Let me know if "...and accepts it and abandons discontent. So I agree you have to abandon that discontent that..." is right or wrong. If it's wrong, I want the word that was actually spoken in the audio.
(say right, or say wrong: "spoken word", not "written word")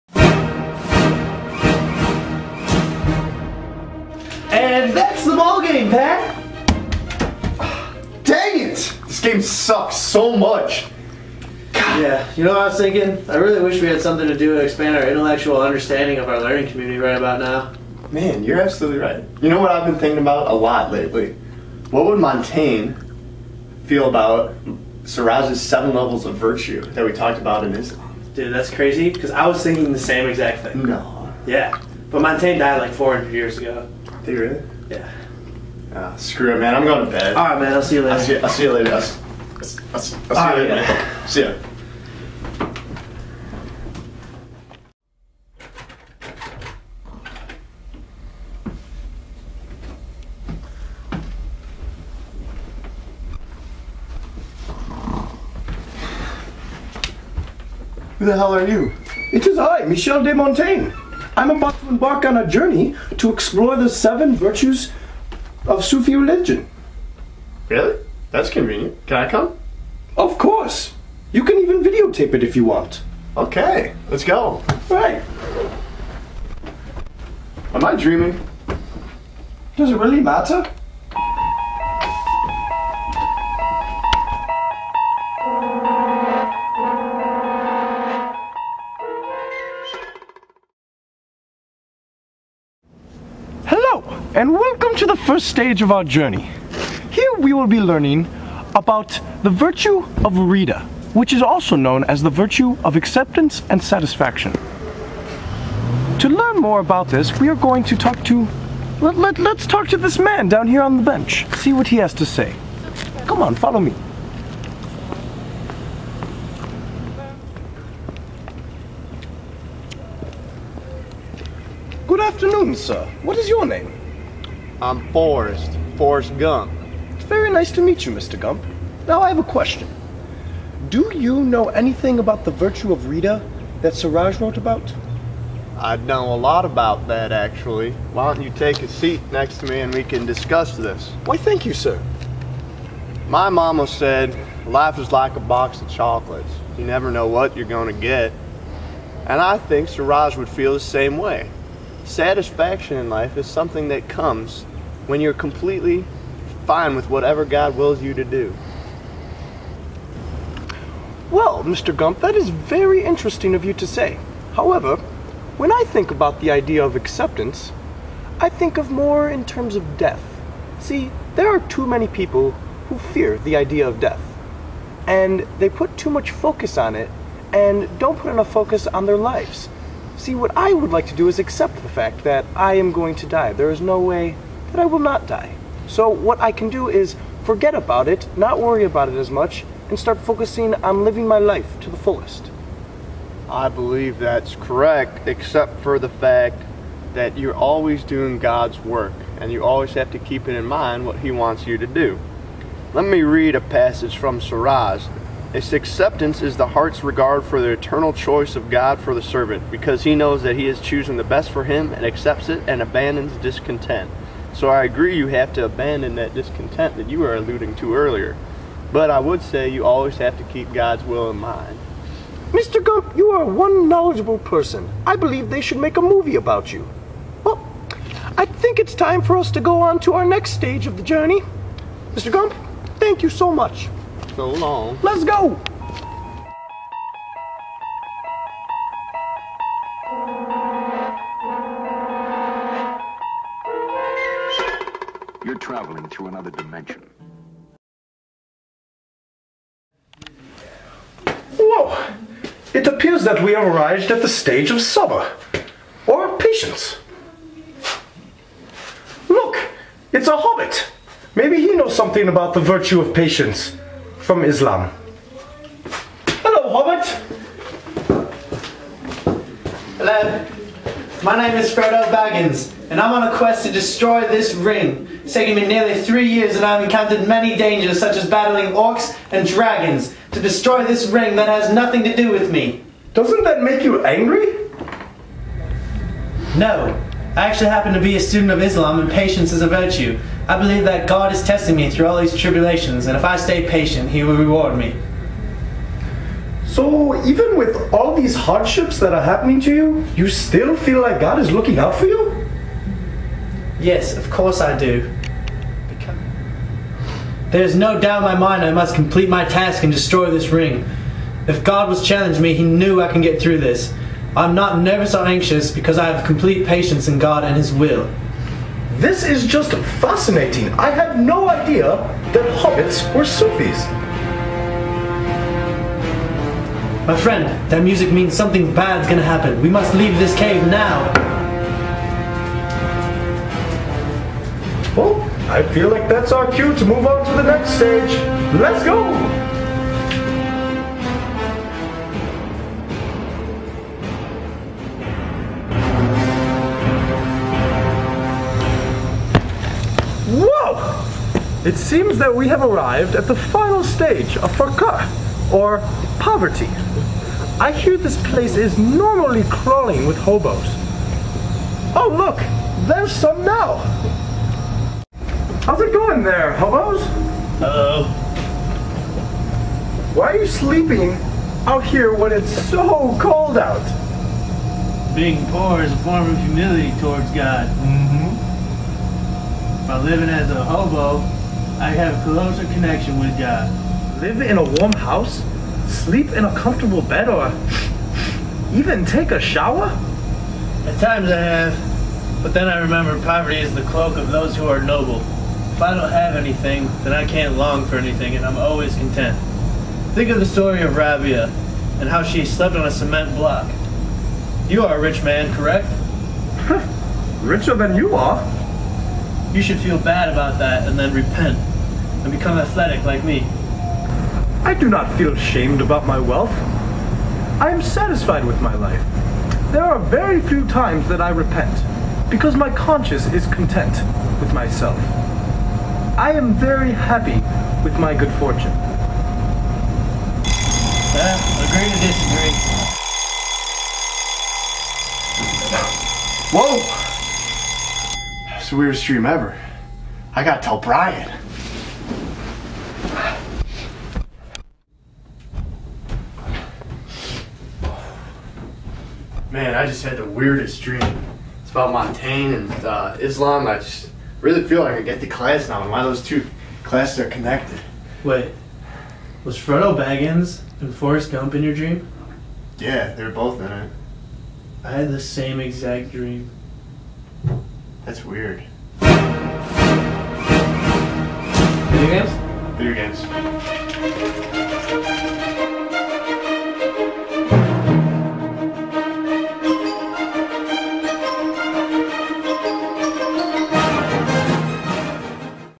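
right.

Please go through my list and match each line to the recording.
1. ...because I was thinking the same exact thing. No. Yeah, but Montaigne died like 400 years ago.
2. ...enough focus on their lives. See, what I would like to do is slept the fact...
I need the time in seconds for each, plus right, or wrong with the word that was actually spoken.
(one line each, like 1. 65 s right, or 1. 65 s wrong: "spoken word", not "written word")
1. 29 s right
2. 178 s wrong: "accept", not "slept".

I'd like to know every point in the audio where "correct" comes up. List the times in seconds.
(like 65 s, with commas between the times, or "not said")
194 s, 405 s.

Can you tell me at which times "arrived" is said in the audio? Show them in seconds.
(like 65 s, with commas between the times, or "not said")
253 s, 352 s.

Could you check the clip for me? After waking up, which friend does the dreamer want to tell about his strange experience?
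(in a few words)
Brian.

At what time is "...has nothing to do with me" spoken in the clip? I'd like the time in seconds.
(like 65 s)
281 s.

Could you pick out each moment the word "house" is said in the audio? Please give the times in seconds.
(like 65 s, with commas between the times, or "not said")
384 s.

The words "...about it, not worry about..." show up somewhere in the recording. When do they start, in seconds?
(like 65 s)
187 s.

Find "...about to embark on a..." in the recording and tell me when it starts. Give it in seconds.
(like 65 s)
61 s.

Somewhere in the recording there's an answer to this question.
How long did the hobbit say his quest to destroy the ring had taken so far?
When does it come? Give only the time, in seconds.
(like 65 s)
275 s.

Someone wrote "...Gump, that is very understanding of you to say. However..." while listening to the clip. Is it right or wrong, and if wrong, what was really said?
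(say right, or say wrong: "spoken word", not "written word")
wrong: "interesting", not "understanding".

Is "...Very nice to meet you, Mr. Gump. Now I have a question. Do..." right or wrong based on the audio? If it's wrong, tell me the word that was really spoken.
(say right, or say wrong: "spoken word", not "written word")
right.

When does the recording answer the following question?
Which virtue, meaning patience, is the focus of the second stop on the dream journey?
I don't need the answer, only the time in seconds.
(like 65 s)
254 s.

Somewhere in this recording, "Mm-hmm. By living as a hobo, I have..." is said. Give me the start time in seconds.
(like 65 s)
377 s.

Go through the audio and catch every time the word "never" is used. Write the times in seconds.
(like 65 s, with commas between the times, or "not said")
146 s.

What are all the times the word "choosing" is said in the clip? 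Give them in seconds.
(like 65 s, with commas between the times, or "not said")
210 s.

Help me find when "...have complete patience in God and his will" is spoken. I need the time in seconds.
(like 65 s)
316 s.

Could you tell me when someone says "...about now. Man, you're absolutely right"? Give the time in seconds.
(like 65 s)
17 s.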